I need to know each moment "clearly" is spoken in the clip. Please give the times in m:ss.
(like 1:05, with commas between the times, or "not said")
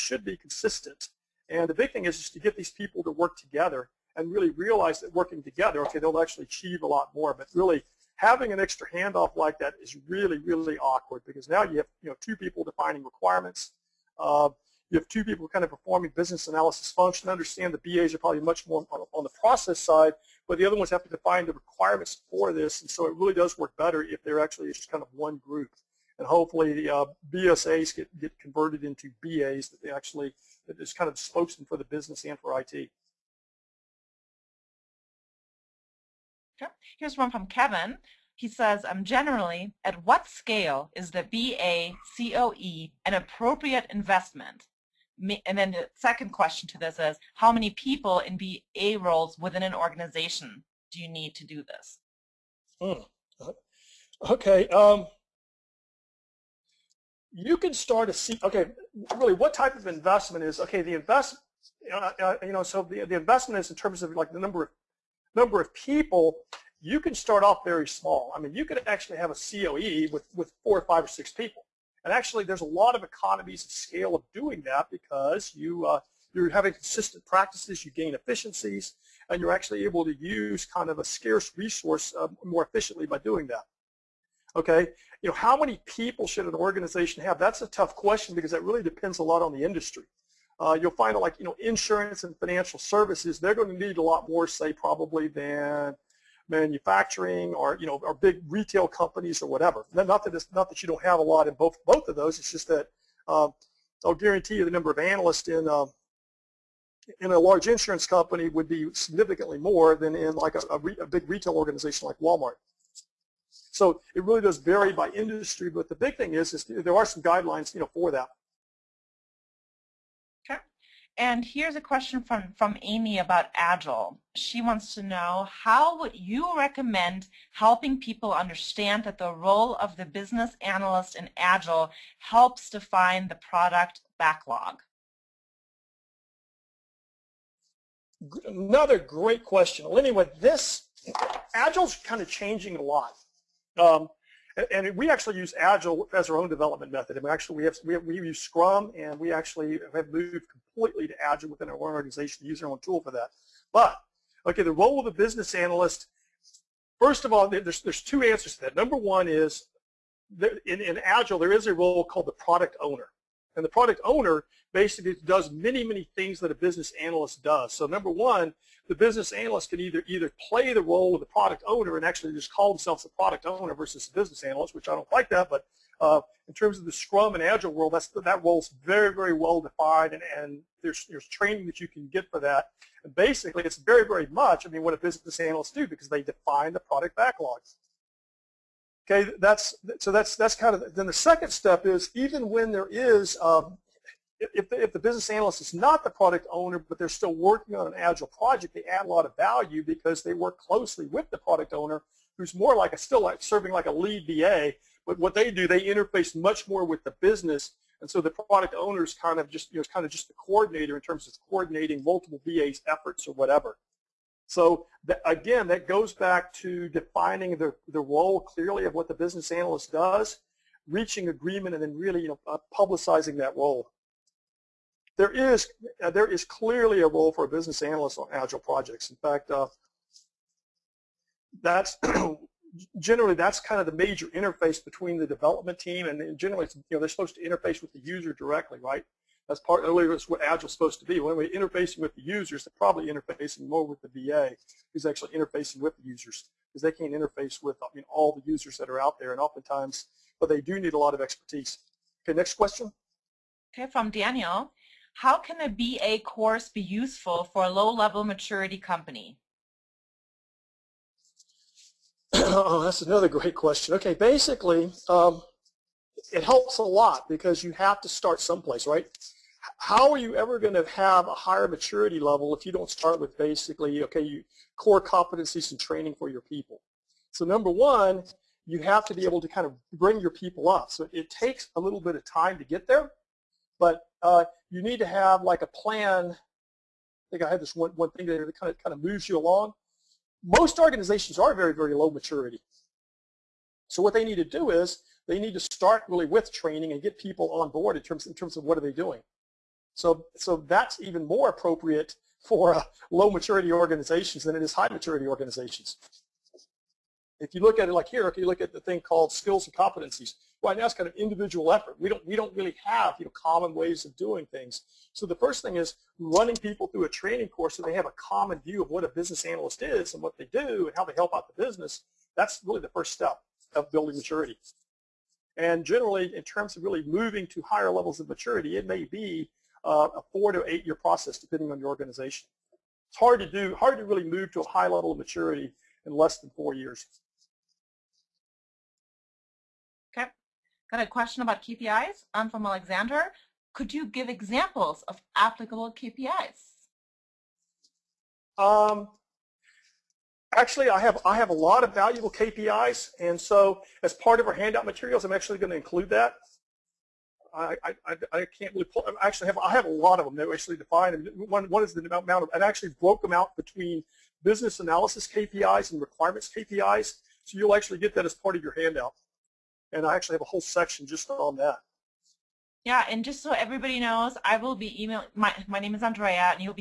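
3:38, 3:46.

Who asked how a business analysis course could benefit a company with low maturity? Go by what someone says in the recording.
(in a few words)
Daniel.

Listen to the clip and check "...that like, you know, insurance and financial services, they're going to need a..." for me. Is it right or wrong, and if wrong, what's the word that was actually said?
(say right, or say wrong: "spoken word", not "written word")
right.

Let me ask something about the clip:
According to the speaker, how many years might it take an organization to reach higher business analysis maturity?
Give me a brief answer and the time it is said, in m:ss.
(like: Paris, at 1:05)
4 to 8 years, at 5:30.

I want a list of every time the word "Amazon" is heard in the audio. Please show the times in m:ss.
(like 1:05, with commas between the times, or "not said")
not said.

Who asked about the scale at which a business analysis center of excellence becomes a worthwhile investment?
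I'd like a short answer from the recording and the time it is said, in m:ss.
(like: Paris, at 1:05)
Kevin, at 0:37.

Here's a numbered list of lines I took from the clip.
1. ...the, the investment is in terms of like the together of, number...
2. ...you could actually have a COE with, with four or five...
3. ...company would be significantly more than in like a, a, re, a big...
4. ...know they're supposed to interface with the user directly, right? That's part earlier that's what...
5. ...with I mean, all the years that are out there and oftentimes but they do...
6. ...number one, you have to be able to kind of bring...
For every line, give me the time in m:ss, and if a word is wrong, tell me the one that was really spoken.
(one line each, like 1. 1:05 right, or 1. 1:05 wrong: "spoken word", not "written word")
1. 1:02 wrong: "number", not "together"
2. 1:08 right
3. 1:48 right
4. 3:56 right
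5. 4:07 wrong: "users", not "years"
6. 4:37 right.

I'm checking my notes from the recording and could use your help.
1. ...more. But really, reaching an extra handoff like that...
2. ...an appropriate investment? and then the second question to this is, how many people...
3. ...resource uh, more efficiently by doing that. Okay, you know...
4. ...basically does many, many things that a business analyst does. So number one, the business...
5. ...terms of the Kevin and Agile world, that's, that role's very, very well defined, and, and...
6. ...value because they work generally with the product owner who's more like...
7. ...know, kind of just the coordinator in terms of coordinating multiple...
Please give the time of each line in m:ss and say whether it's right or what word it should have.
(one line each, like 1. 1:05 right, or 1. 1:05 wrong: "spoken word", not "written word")
1. 0:07 wrong: "having", not "reaching"
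2. 0:43 right
3. 1:21 right
4. 2:44 right
5. 2:56 wrong: "Scrum", not "Kevin"
6. 3:19 wrong: "closely", not "generally"
7. 3:29 right.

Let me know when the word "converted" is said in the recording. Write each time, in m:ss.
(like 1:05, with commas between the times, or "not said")
0:28.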